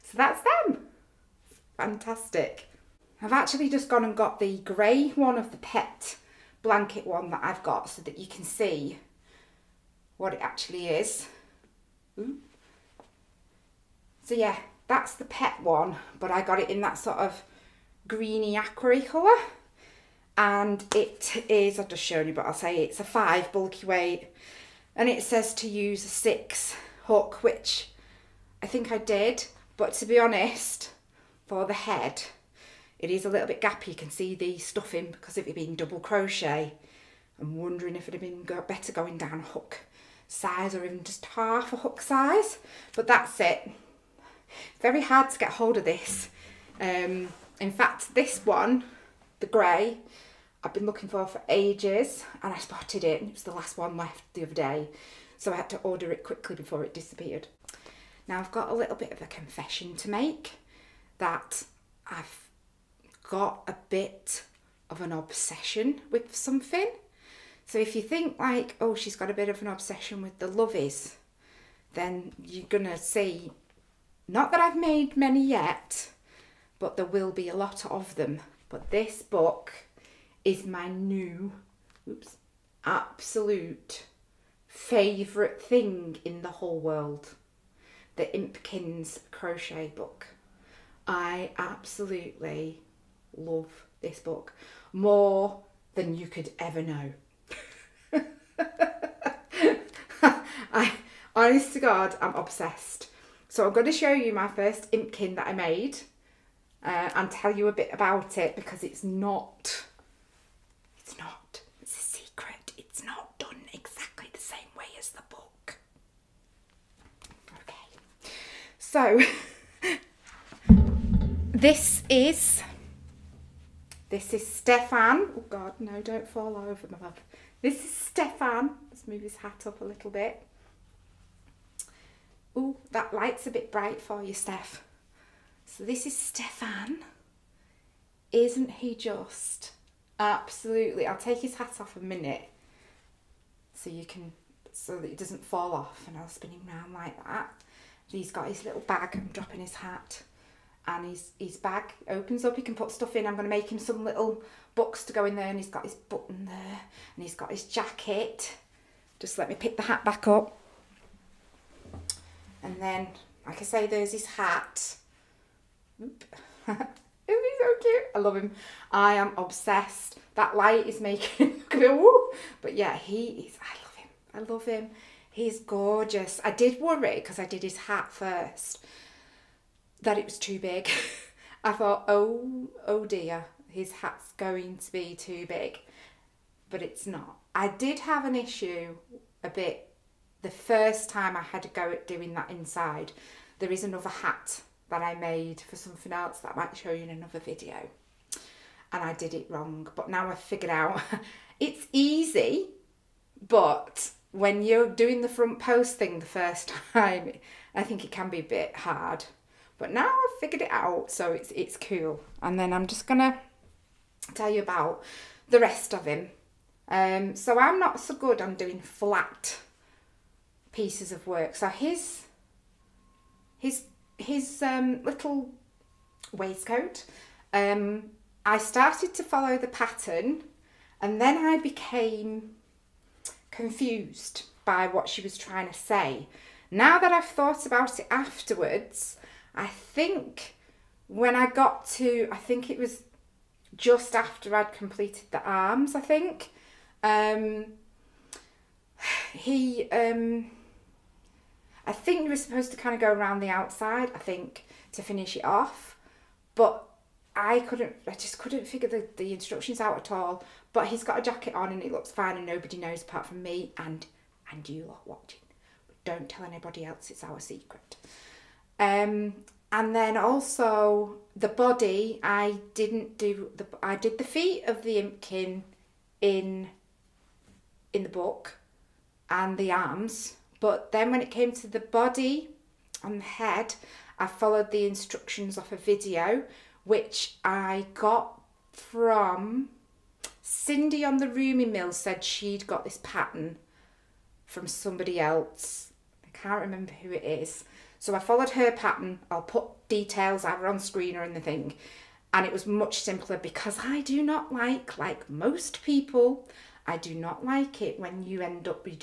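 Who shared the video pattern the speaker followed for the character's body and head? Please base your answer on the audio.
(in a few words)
Cindy.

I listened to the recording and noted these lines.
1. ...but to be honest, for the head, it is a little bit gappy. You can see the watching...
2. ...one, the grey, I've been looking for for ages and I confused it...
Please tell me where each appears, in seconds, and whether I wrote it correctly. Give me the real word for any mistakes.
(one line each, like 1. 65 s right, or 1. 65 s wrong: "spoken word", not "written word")
1. 29 s wrong: "stuffing", not "watching"
2. 48 s wrong: "spotted", not "confused".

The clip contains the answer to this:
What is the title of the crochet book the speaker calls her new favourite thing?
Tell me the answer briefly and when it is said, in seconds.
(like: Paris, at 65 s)
The Impkins crochet book, at 88 s.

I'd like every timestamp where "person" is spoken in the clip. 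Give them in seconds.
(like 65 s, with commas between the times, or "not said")
not said.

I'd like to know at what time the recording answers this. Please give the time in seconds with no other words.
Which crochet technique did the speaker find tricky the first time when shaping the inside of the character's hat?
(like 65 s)
205 s.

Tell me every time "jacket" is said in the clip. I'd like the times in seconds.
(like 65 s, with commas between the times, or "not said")
157 s, 261 s.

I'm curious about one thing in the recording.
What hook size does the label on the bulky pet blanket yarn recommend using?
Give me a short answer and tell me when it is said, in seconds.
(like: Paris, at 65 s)
6, at 26 s.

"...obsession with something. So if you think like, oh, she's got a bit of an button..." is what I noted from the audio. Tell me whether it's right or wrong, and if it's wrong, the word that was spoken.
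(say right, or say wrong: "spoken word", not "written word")
wrong: "obsession", not "button".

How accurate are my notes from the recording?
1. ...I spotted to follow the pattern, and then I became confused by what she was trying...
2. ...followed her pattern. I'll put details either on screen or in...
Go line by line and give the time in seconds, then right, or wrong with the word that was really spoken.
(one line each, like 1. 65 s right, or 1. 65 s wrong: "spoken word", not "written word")
1. 228 s wrong: "started", not "spotted"
2. 298 s right.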